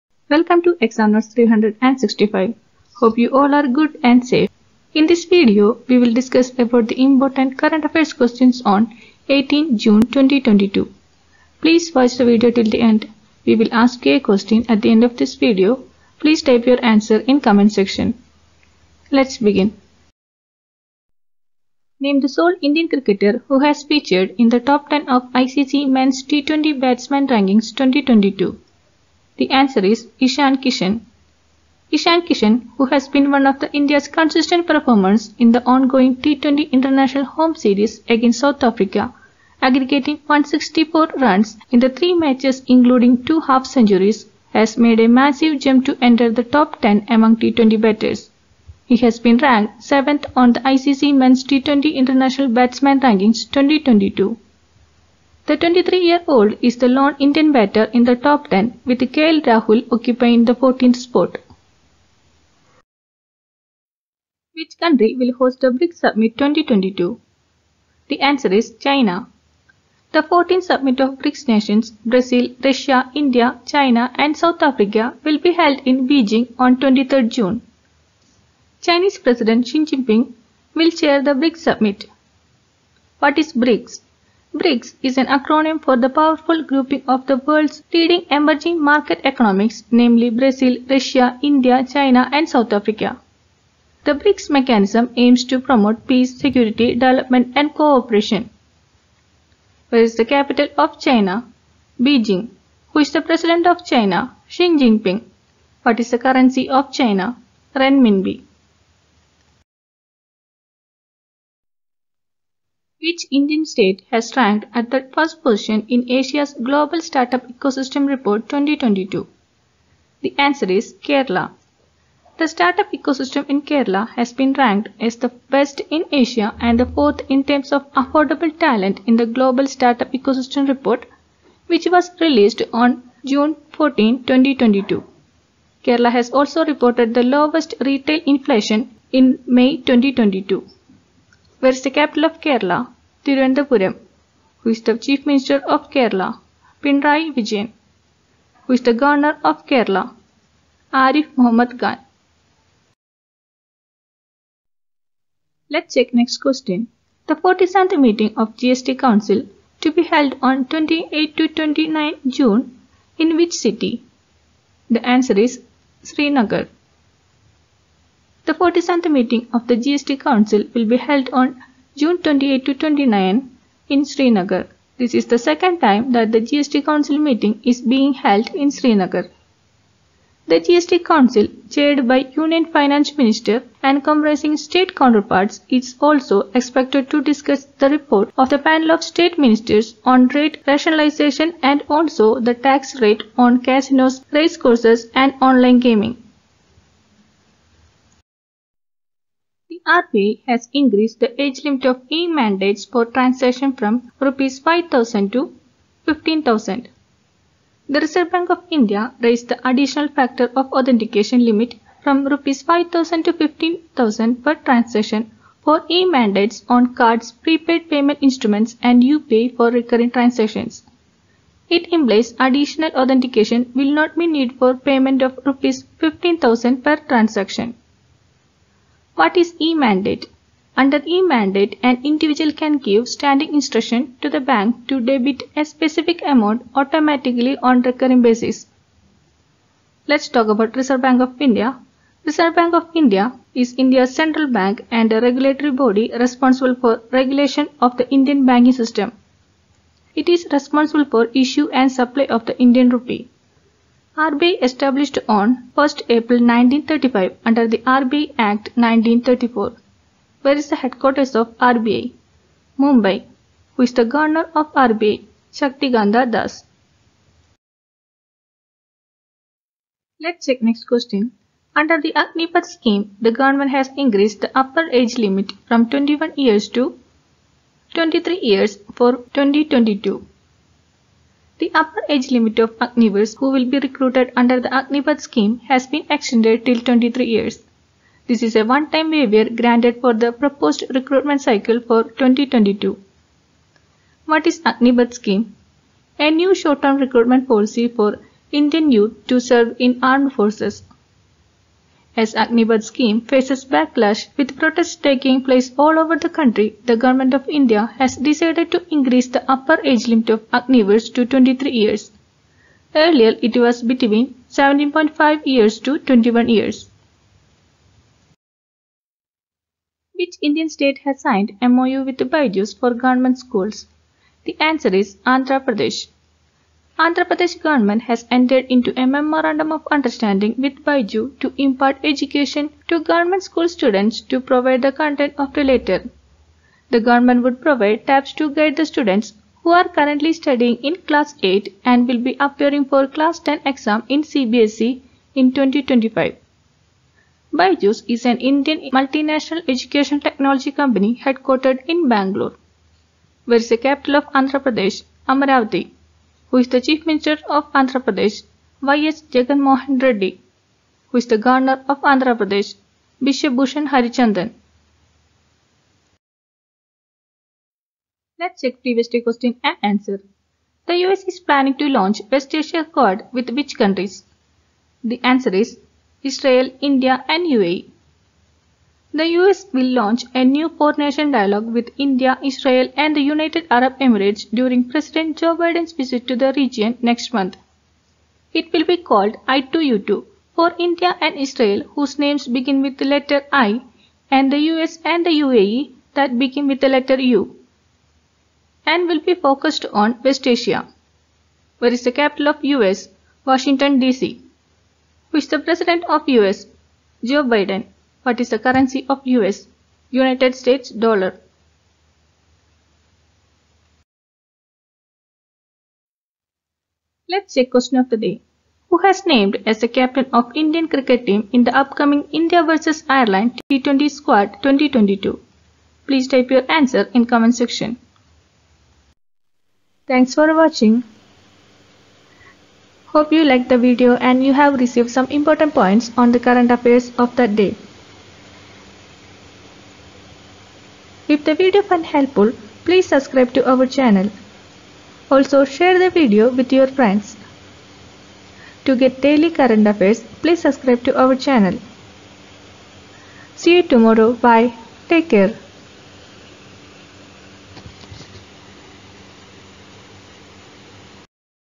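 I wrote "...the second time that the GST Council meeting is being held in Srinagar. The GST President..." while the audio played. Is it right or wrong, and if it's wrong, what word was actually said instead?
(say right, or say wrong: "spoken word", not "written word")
wrong: "Council", not "President".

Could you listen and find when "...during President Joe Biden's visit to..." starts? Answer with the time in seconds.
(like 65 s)
384 s.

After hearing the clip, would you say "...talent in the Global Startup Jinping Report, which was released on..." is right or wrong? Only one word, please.
wrong.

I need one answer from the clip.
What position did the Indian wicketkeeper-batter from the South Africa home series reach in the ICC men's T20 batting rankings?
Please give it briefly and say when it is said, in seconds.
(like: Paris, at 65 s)
7th, at 49 s.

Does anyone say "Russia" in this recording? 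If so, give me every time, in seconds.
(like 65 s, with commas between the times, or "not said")
72 s, 90 s.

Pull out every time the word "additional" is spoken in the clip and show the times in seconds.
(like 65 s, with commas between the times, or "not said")
209 s, 222 s.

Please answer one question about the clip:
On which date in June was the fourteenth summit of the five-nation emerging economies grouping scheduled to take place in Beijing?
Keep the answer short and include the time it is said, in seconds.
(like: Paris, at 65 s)
23rd June, at 76 s.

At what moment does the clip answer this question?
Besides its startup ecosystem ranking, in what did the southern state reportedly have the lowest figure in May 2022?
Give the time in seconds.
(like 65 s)
137 s.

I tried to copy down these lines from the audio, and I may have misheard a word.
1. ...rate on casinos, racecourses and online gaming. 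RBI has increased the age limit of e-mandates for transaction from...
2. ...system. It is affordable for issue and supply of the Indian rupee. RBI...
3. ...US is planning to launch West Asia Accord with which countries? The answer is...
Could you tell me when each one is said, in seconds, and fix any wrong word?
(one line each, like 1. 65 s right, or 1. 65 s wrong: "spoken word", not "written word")
1. 192 s right
2. 248 s wrong: "responsible", not "affordable"
3. 371 s right.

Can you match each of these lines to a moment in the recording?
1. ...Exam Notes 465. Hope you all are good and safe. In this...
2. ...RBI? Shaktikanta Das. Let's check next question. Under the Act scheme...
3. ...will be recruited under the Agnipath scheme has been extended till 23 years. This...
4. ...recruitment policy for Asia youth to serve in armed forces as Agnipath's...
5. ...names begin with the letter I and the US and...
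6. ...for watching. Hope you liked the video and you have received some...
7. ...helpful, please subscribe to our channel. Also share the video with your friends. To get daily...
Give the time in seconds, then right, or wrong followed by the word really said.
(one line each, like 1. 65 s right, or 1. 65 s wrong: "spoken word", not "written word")
1. 0 s wrong: "365", not "465"
2. 264 s wrong: "Agnipath", not "Act"
3. 283 s right
4. 296 s wrong: "Indian", not "Asia"
5. 392 s right
6. 430 s right
7. 442 s right.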